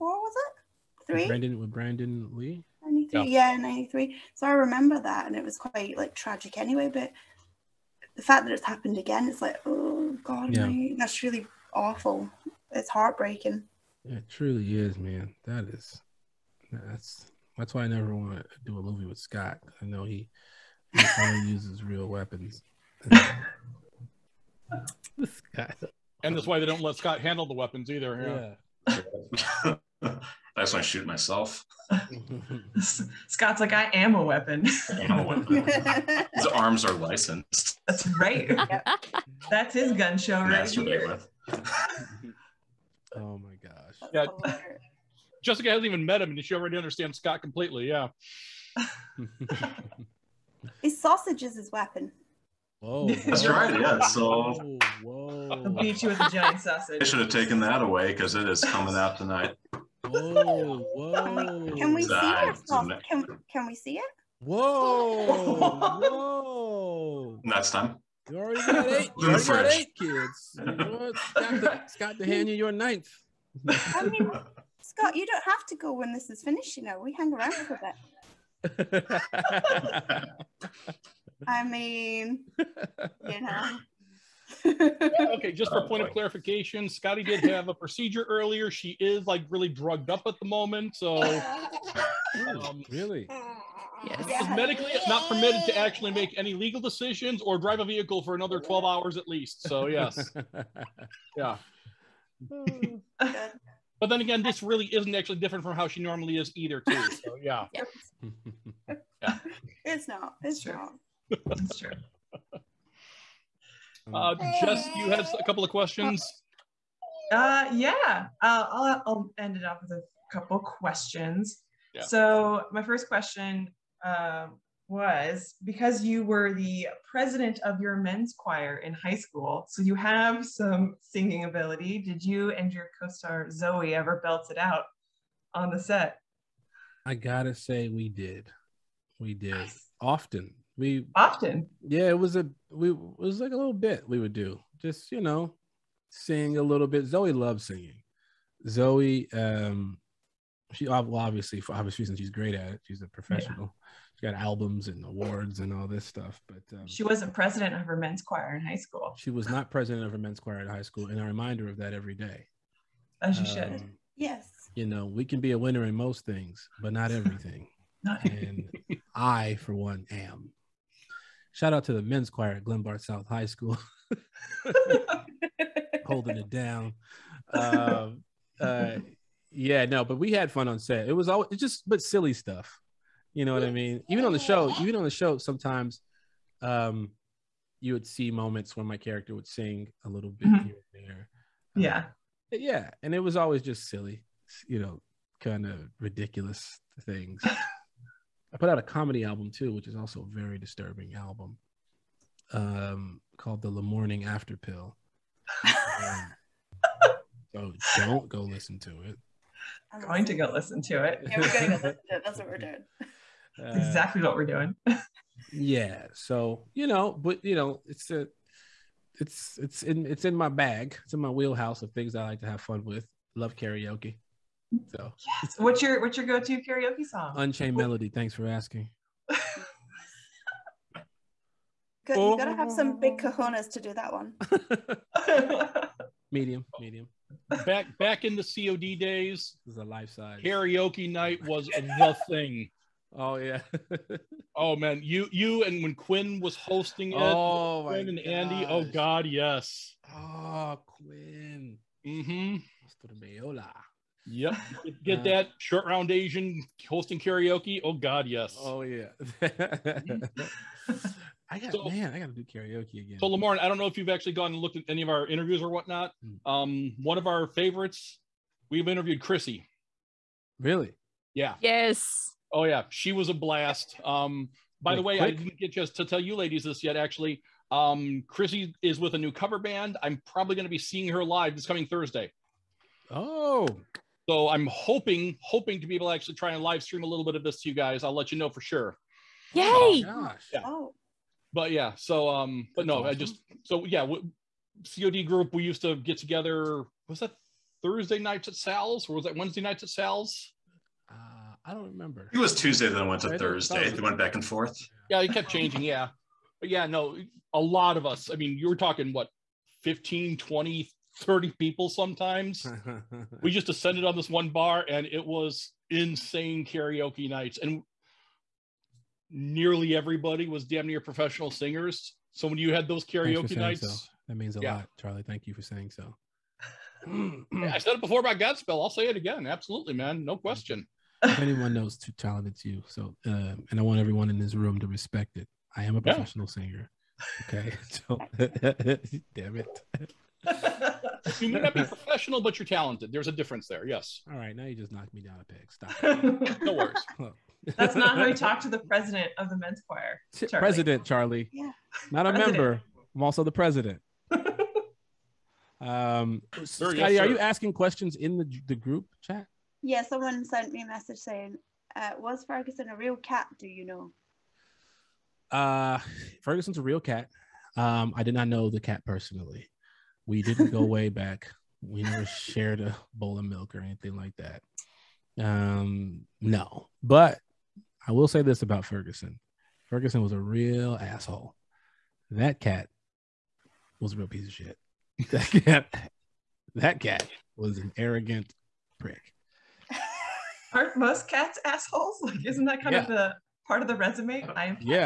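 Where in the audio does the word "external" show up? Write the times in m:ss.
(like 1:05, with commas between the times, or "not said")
not said.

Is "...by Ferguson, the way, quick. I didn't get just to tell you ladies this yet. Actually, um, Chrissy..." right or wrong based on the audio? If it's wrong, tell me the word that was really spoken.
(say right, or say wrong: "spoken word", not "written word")
wrong: "Wait", not "Ferguson".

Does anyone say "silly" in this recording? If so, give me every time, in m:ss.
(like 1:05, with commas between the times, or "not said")
3:02, 3:13.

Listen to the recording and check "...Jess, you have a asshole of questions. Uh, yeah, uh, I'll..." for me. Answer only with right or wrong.
wrong.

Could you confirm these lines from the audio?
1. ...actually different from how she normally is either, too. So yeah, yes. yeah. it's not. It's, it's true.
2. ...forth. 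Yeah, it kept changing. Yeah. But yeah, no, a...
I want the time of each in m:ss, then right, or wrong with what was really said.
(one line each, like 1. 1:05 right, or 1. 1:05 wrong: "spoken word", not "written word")
1. 1:45 right
2. 5:04 right.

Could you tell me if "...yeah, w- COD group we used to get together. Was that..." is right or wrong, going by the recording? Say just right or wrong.
right.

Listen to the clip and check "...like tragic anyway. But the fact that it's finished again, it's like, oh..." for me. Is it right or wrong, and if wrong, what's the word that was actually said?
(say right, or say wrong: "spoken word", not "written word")
wrong: "happened", not "finished".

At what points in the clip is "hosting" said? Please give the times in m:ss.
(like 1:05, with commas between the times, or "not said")
4:06, 4:16.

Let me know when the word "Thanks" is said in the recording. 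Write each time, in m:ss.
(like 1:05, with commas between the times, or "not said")
3:48, 5:25.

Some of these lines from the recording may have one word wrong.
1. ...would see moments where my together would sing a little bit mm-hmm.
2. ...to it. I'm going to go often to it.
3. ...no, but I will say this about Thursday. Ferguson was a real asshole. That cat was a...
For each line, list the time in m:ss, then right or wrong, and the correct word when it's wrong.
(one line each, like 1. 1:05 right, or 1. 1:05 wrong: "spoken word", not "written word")
1. 3:07 wrong: "character", not "together"
2. 3:28 wrong: "listen", not "often"
3. 6:16 wrong: "Ferguson", not "Thursday".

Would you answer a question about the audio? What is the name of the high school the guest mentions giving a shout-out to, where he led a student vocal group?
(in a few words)
Glenbard South High School.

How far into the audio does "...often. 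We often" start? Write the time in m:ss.
2:19.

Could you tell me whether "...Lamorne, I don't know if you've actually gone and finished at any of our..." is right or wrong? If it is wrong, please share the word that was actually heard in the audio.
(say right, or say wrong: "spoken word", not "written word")
wrong: "looked", not "finished".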